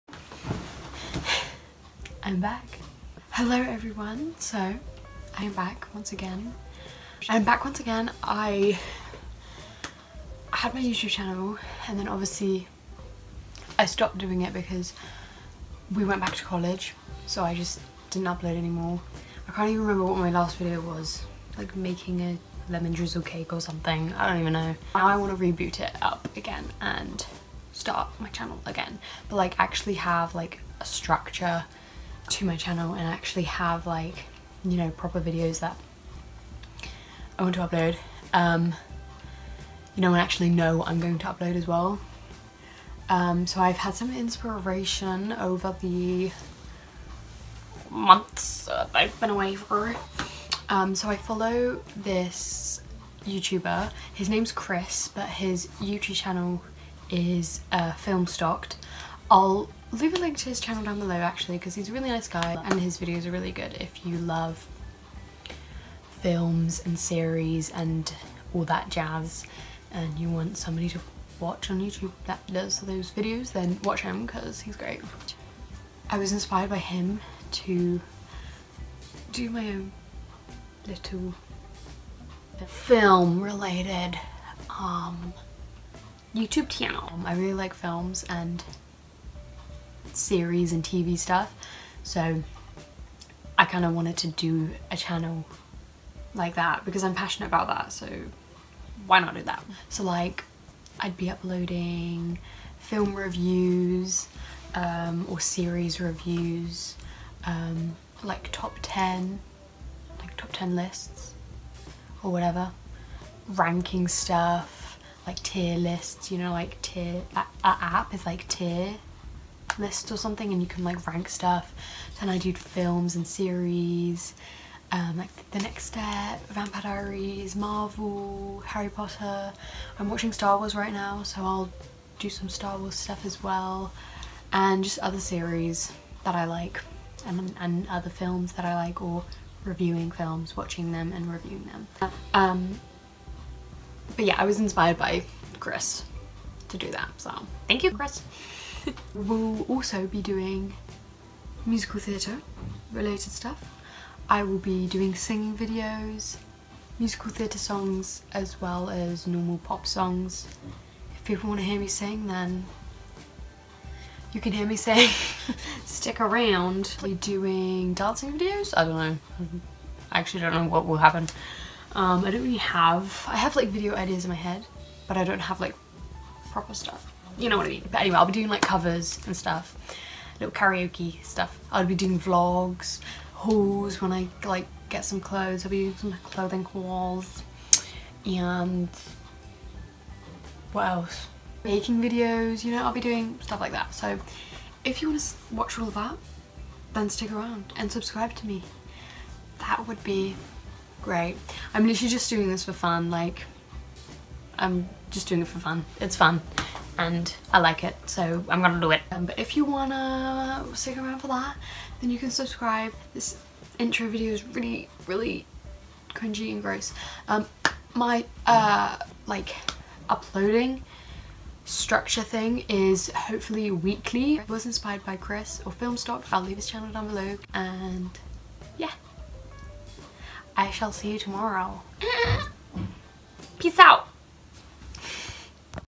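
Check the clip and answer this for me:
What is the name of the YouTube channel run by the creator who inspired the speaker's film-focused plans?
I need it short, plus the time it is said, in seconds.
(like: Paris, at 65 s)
Film Stocked, at 57 s.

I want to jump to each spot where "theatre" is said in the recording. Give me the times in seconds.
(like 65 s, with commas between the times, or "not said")
151 s, 157 s.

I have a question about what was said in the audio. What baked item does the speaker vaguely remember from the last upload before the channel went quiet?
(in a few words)
Lemon drizzle cake.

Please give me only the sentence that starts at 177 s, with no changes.
But anyway, I'll be doing like covers and stuff, little karaoke stuff.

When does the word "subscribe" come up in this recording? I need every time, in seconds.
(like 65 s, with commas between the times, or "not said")
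197 s, 212 s.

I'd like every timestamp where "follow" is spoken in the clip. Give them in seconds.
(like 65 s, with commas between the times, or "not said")
51 s.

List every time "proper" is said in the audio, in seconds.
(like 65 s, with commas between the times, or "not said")
34 s, 176 s.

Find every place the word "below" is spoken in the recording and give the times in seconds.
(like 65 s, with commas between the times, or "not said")
60 s, 227 s.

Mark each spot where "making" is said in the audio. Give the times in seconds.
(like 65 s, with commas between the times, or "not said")
21 s, 191 s.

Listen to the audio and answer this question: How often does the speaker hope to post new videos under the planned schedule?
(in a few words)
Weekly.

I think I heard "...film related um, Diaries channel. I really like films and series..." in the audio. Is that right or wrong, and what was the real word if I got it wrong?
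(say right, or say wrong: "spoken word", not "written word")
wrong: "YouTube", not "Diaries".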